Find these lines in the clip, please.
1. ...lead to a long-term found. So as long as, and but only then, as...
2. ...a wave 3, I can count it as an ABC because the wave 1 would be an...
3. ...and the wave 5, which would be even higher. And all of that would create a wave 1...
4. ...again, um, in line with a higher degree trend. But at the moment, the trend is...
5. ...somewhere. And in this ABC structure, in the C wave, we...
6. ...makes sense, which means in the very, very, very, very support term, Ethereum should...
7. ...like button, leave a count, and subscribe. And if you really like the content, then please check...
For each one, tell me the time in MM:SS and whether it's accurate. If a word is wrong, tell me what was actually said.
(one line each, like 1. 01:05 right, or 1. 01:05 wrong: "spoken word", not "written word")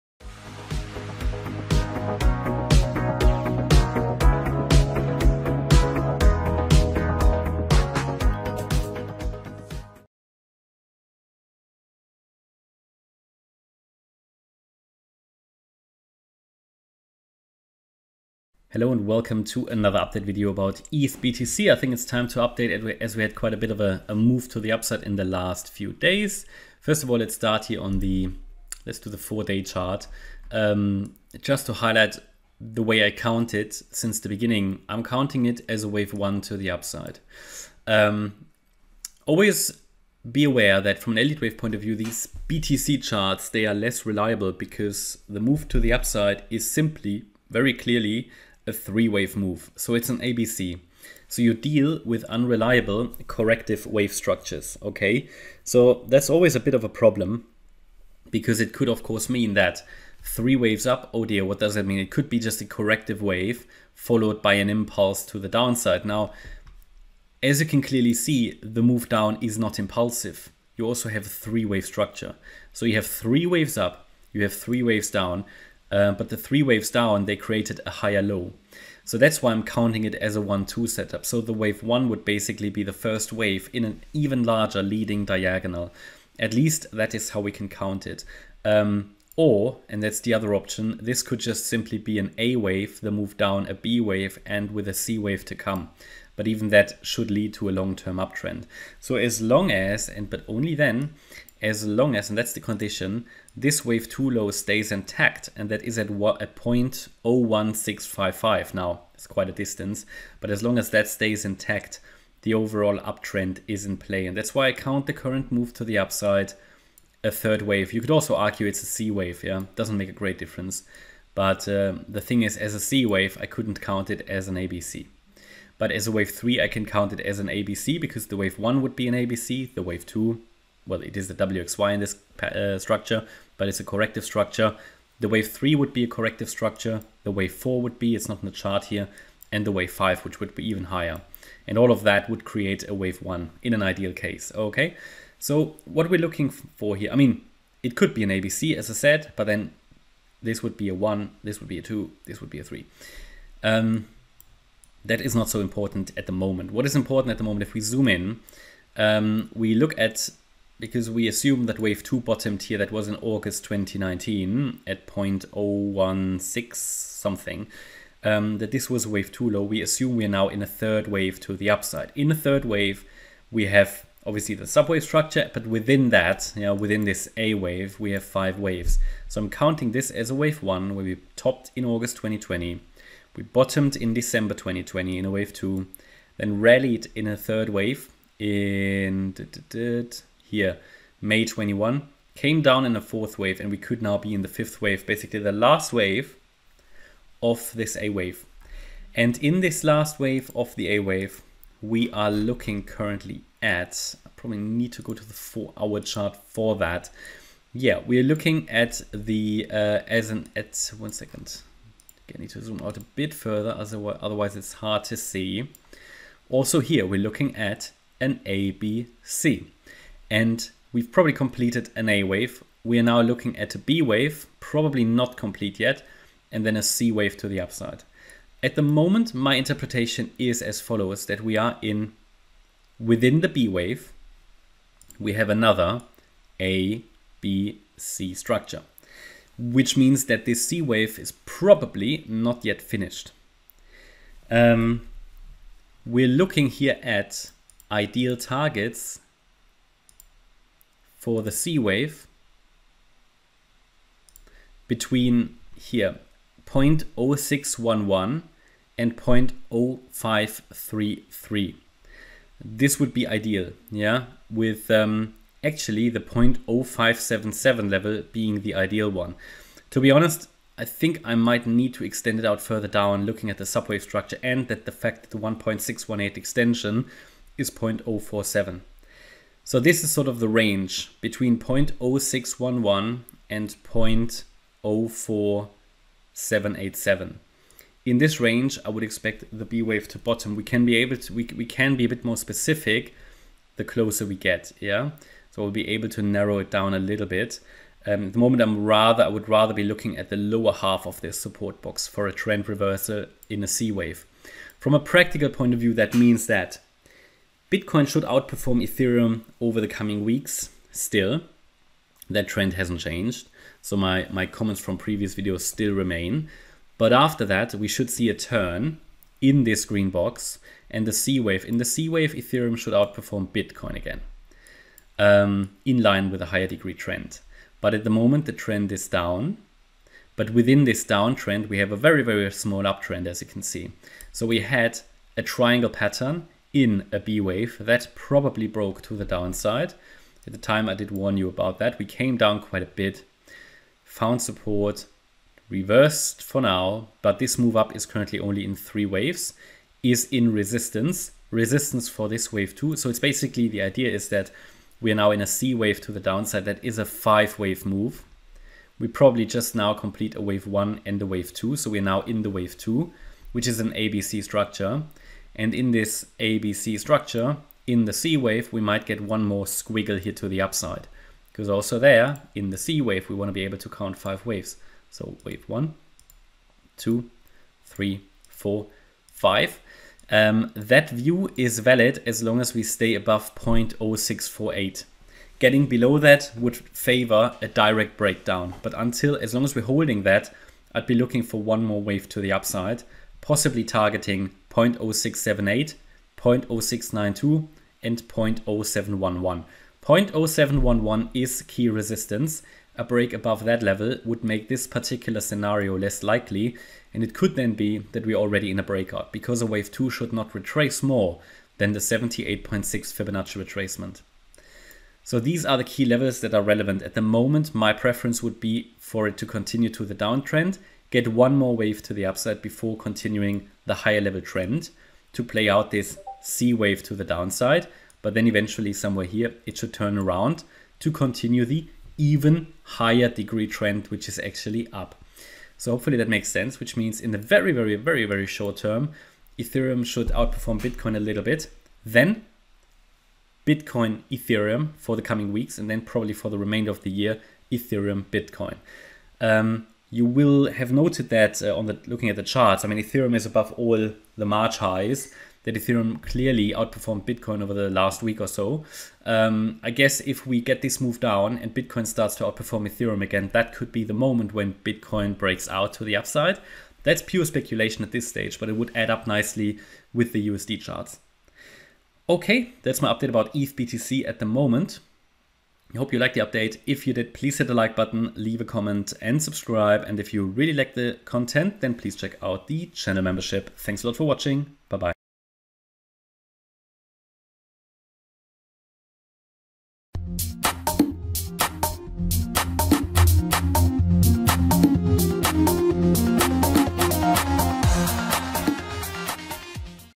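1. 01:37 wrong: "uptrend", not "found"
2. 02:06 right
3. 02:19 right
4. 05:23 right
5. 06:04 wrong: "structure", not "somewhere"
6. 07:16 wrong: "short", not "support"
7. 07:57 wrong: "comment", not "count".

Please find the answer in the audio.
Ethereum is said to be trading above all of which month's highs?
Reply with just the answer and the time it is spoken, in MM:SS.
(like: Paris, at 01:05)
March, at 07:34.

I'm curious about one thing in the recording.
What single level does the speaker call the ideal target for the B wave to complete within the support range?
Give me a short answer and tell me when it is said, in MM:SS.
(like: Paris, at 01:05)
0.0577, at 04:26.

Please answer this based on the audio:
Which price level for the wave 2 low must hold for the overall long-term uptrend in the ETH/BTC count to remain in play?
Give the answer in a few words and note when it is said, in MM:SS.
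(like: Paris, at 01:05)
0.01655, at 01:46.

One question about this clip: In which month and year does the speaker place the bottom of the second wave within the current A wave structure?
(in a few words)
December 2020.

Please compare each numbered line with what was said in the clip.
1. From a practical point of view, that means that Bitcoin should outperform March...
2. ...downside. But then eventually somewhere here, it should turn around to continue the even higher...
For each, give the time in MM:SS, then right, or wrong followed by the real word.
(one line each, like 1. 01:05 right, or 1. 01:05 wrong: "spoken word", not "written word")
1. 05:04 wrong: "Ethereum", not "March"
2. 07:07 right.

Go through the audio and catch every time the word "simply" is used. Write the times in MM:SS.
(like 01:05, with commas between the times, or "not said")
00:46, 01:31.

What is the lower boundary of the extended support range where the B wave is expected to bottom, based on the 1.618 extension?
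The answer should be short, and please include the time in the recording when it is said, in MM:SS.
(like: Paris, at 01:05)
0.04787, at 04:43.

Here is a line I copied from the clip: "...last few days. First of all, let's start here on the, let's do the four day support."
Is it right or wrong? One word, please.
wrong.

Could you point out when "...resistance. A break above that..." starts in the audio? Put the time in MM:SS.
06:41.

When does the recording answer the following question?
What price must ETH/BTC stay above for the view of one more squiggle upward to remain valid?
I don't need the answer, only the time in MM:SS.
06:23.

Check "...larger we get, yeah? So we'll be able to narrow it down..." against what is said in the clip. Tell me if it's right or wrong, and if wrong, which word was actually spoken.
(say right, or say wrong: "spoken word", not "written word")
wrong: "closer", not "larger".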